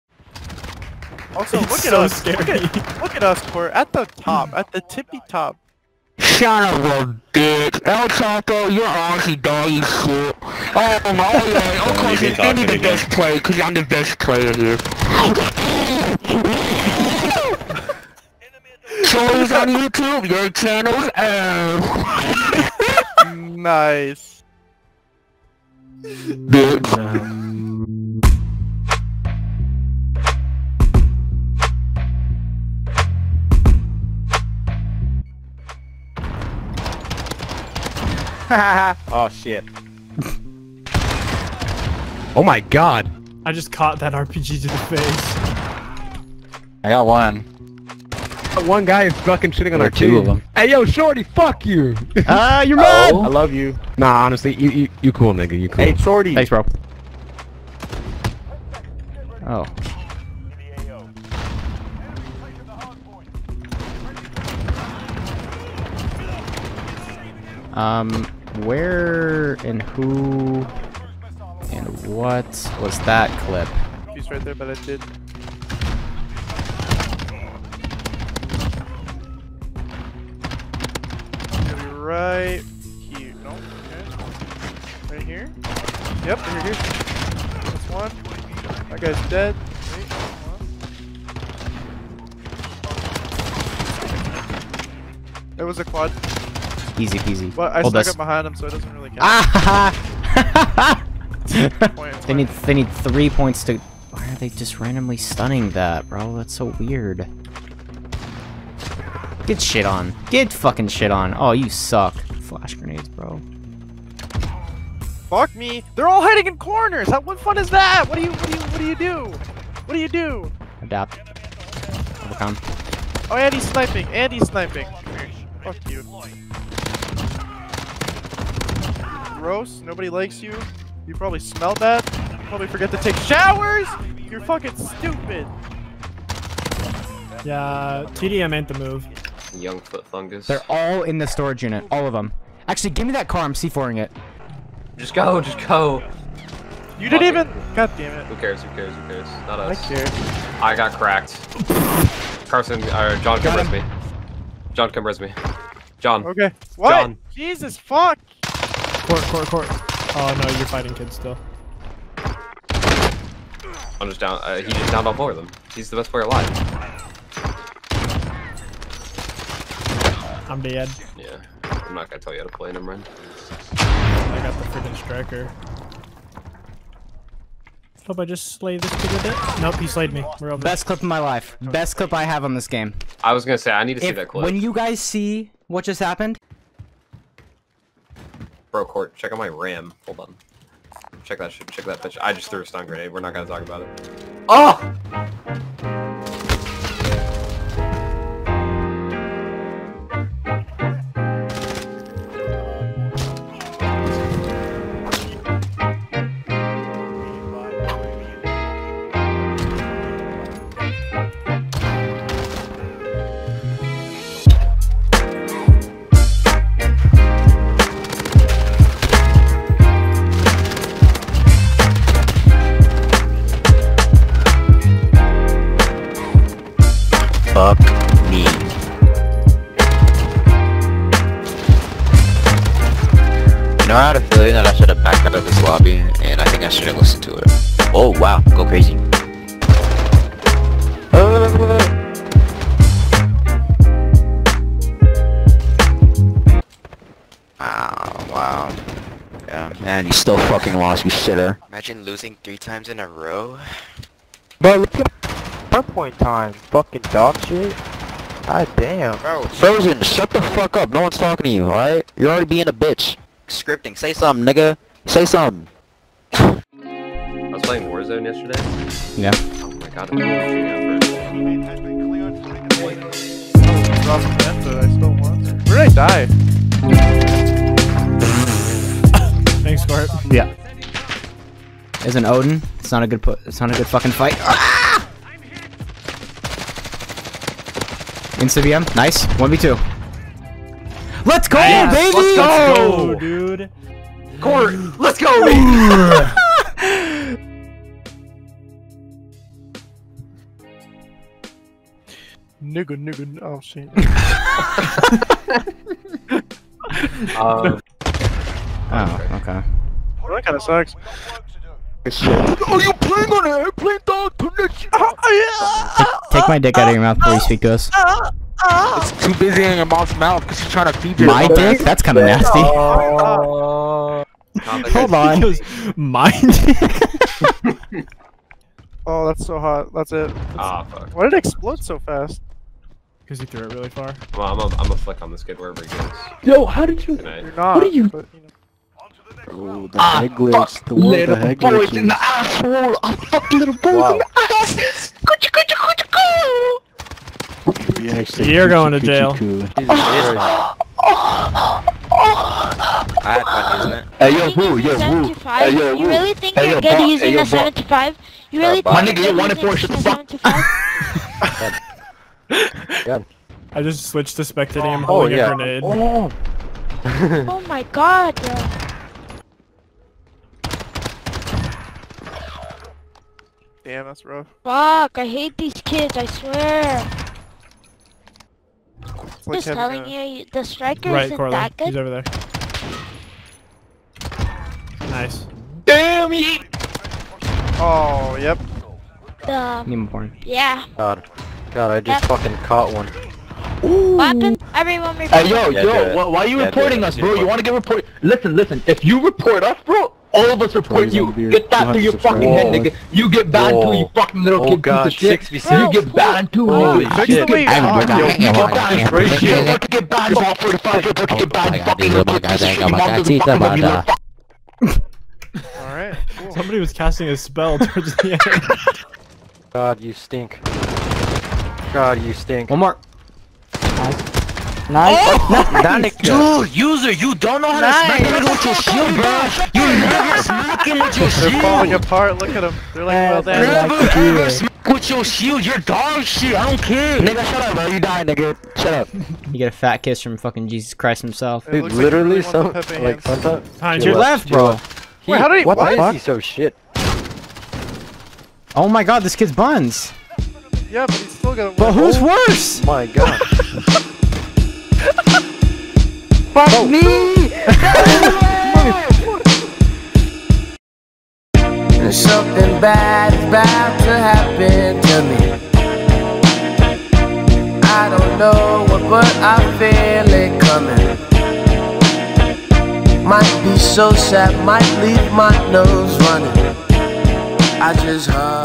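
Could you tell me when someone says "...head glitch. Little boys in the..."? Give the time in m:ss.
5:41.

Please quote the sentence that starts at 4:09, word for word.
Man, you still fucking lost, you shitter.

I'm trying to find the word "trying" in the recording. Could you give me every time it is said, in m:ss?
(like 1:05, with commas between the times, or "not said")
5:20.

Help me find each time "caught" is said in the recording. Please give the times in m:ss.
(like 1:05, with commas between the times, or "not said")
0:43, 6:32.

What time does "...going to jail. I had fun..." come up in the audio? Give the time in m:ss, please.
5:48.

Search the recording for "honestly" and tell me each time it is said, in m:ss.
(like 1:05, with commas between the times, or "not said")
0:08, 0:54.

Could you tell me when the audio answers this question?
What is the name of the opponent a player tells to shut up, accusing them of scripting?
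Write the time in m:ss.
4:19.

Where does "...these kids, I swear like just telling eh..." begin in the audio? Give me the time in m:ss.
6:15.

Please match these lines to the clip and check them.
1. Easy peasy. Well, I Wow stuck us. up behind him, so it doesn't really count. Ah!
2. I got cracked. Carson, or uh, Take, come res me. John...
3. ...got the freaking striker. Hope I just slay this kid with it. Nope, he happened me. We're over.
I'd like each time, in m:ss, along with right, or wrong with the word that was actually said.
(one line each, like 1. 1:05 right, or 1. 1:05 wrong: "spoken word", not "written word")
1. 1:37 wrong: "Hold", not "Wow"
2. 2:30 wrong: "John", not "Take"
3. 2:54 wrong: "slayed", not "happened".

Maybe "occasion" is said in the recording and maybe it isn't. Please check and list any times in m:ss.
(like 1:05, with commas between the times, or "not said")
not said.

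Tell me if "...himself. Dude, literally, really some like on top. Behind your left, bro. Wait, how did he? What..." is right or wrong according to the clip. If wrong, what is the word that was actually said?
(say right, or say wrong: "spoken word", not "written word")
right.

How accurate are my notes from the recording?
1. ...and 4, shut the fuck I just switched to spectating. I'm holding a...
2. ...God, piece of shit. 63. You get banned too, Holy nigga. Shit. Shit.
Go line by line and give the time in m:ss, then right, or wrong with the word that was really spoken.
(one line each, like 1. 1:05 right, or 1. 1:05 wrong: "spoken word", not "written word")
1. 5:59 right
2. 6:44 wrong: "66", not "63".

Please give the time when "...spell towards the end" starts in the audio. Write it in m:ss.
6:57.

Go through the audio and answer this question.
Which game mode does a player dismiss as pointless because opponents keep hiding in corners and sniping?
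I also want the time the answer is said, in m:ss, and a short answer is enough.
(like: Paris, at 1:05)
TDM, at 2:18.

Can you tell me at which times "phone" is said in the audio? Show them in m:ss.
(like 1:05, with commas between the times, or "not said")
not said.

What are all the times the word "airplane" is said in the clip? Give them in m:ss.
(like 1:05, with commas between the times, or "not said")
5:13.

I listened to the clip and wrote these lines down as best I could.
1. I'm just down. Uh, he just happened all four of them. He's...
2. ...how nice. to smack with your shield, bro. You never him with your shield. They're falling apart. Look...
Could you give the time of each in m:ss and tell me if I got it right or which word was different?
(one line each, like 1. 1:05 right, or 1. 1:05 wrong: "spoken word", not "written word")
1. 2:43 wrong: "downed", not "happened"
2. 7:07 right.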